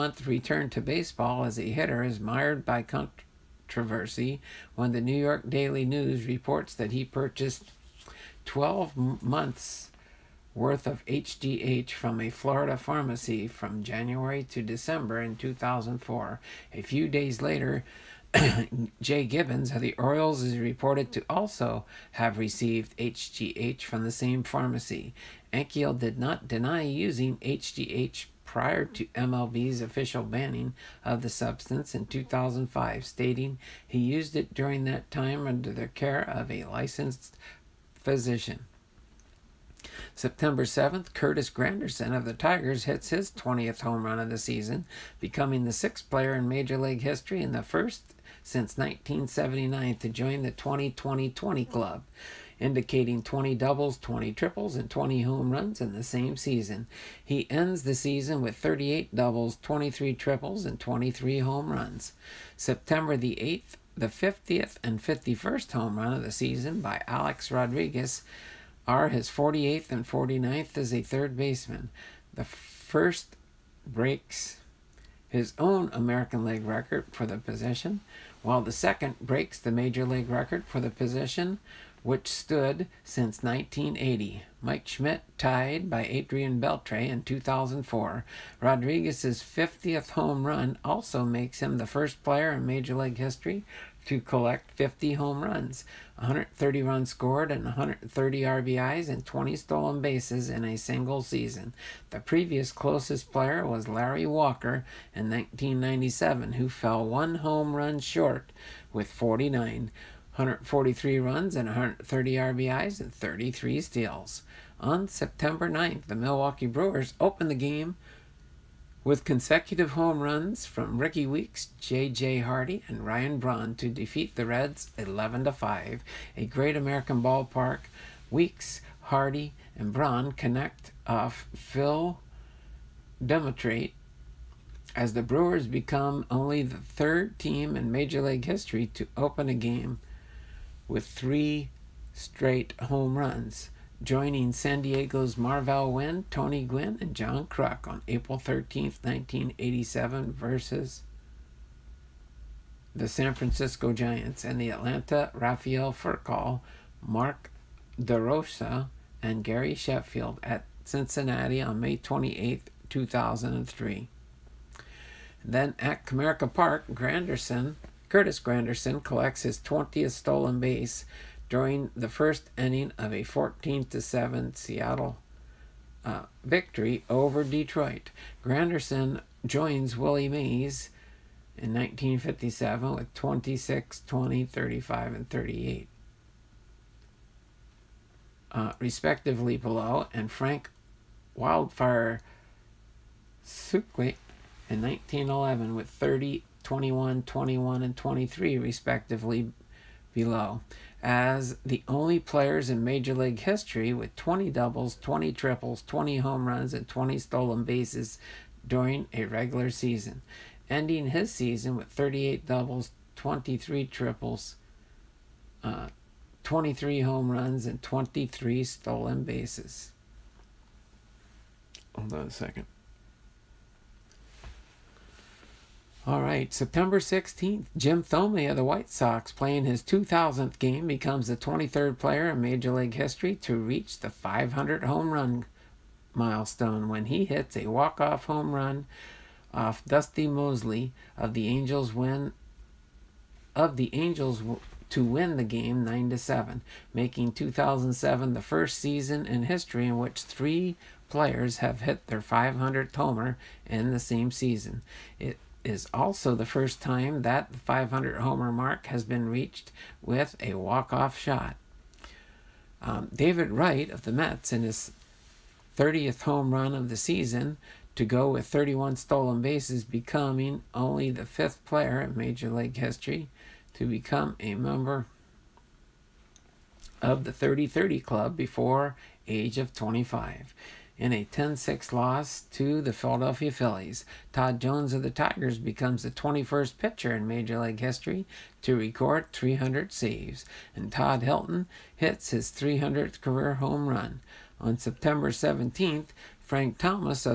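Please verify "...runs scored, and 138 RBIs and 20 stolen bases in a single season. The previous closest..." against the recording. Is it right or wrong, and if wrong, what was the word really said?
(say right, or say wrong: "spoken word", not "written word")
wrong: "130", not "138".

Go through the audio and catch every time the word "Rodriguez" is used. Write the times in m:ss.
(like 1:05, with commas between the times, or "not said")
1:07, 1:28.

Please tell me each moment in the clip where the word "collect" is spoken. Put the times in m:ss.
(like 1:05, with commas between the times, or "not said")
1:34, 2:49.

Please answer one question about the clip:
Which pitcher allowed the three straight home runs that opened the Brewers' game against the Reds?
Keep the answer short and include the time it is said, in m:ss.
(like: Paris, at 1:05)
Phil Dumatrait, at 2:11.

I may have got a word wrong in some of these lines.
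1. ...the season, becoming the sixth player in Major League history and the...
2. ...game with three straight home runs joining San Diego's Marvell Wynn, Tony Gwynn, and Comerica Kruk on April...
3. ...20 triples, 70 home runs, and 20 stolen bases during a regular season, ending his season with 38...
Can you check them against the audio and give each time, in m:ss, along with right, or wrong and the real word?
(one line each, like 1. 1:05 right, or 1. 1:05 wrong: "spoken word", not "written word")
1. 0:44 right
2. 2:19 wrong: "John", not "Comerica"
3. 3:25 wrong: "20", not "70".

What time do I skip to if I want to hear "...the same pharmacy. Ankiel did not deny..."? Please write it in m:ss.
0:24.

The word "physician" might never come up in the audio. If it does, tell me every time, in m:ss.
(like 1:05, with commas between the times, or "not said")
0:37.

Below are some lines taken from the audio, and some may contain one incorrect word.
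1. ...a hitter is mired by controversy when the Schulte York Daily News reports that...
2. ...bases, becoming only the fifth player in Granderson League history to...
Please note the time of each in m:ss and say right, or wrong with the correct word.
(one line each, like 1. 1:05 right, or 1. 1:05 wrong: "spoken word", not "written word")
1. 0:01 wrong: "New", not "Schulte"
2. 4:29 wrong: "Major", not "Granderson".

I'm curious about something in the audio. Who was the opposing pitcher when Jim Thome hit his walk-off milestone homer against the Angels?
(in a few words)
Dusty Moseley.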